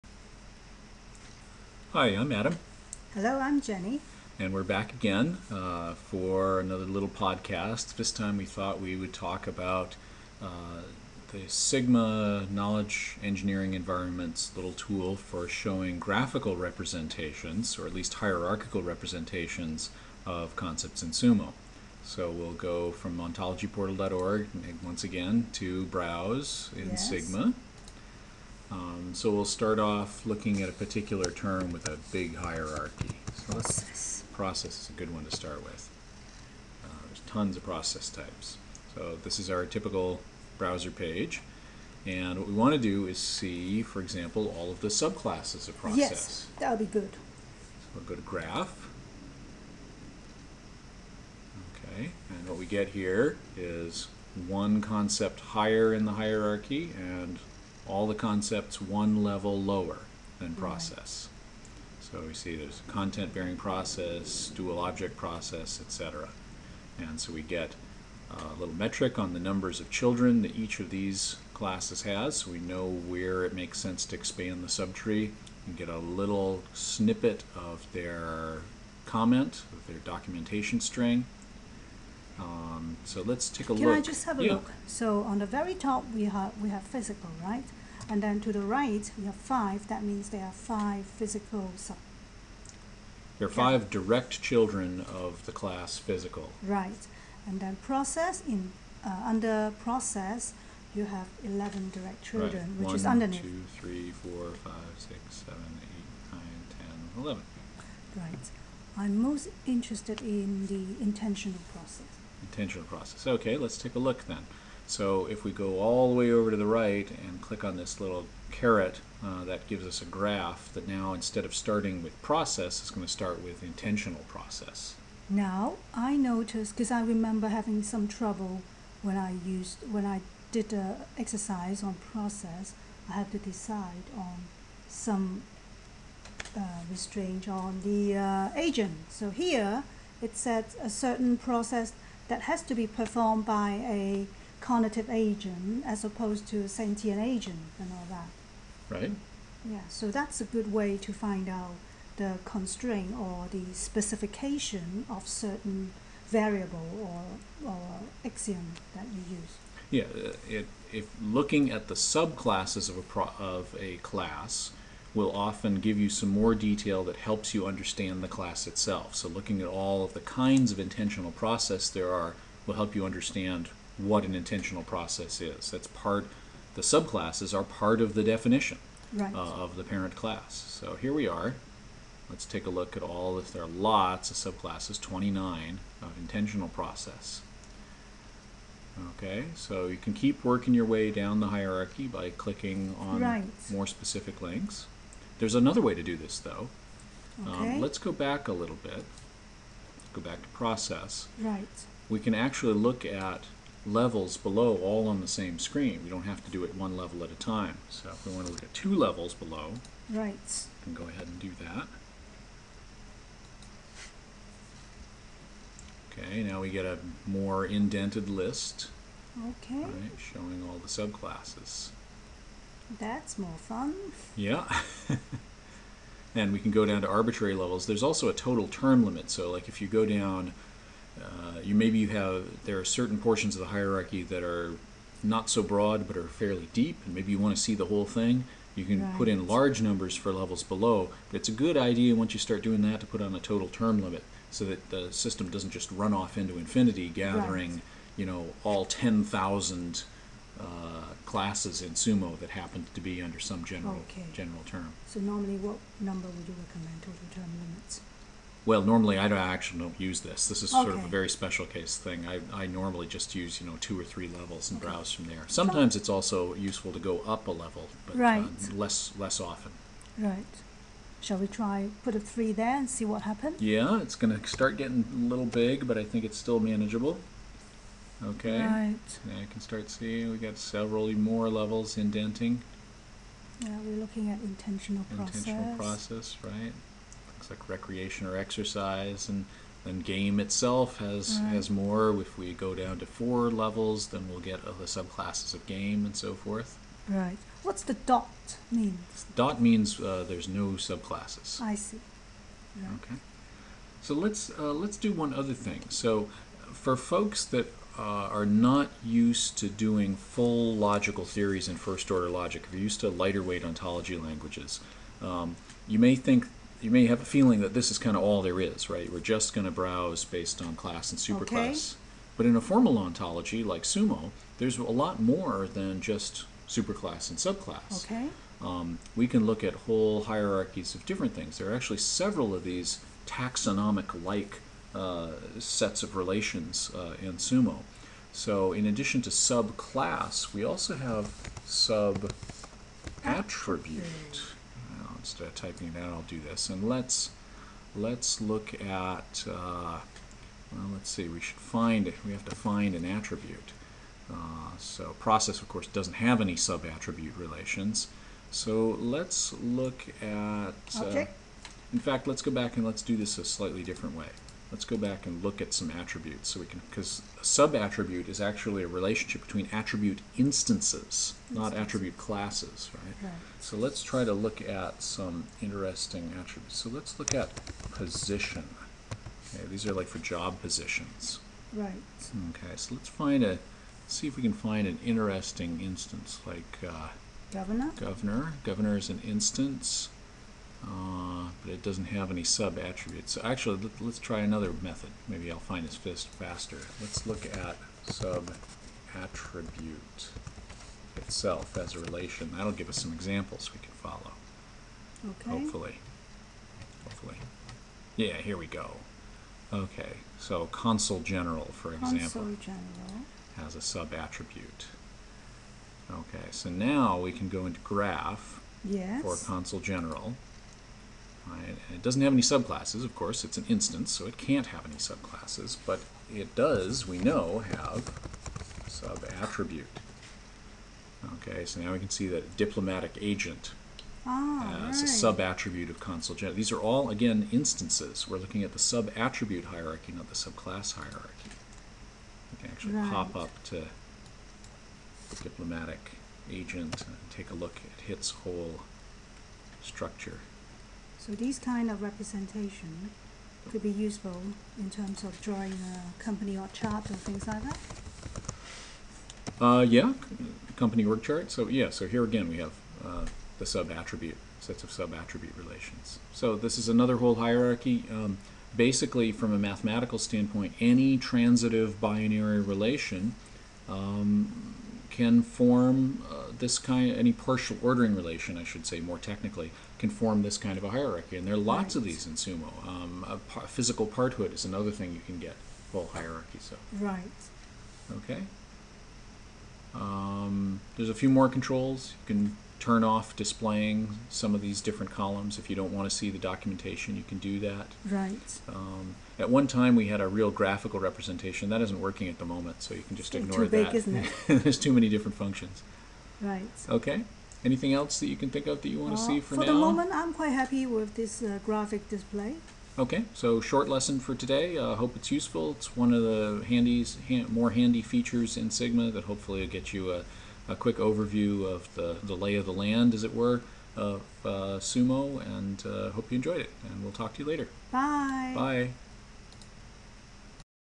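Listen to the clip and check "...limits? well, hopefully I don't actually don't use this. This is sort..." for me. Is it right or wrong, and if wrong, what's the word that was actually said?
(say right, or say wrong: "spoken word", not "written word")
wrong: "normally", not "hopefully".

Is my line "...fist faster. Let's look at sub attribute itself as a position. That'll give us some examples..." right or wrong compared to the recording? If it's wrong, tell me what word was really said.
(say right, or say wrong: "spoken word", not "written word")
wrong: "relation", not "position".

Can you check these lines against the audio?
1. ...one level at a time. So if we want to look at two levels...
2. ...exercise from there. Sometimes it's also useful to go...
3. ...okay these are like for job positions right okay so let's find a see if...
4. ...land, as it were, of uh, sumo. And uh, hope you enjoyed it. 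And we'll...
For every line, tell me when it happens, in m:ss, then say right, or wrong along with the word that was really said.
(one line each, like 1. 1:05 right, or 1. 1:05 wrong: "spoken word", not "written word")
1. 3:26 right
2. 4:24 wrong: "browse", not "exercise"
3. 6:19 right
4. 8:42 right.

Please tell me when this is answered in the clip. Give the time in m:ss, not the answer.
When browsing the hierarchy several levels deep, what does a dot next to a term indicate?
5:00.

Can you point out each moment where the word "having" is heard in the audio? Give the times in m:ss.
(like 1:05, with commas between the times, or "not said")
2:07.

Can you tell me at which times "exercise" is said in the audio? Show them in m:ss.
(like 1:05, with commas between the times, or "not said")
2:11, 4:48.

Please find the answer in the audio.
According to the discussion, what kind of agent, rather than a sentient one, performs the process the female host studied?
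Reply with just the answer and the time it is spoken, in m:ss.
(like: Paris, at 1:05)
cognitive agent, at 2:24.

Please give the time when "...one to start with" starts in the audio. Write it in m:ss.
0:35.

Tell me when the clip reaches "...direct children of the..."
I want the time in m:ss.
1:33.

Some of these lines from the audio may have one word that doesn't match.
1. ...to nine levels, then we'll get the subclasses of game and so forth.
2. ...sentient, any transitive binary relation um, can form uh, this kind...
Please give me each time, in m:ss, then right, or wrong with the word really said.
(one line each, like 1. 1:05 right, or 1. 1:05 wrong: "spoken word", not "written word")
1. 4:52 wrong: "four", not "nine"
2. 7:50 wrong: "standpoint", not "sentient".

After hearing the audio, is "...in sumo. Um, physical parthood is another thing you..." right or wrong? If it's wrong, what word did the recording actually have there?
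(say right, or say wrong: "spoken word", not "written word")
right.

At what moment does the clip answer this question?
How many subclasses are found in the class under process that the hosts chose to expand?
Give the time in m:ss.
3:05.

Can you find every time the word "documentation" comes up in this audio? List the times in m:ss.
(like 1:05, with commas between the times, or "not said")
1:19, 8:16.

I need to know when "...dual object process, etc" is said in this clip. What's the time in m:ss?
1:04.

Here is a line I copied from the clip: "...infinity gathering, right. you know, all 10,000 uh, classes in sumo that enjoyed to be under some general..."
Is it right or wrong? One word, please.
wrong.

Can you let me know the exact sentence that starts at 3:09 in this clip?
Okay, so you can keep working your way down the hierarchy by clicking on right.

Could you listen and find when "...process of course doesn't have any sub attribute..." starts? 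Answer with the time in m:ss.
5:55.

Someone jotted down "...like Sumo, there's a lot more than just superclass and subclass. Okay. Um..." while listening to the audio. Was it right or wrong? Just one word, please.
right.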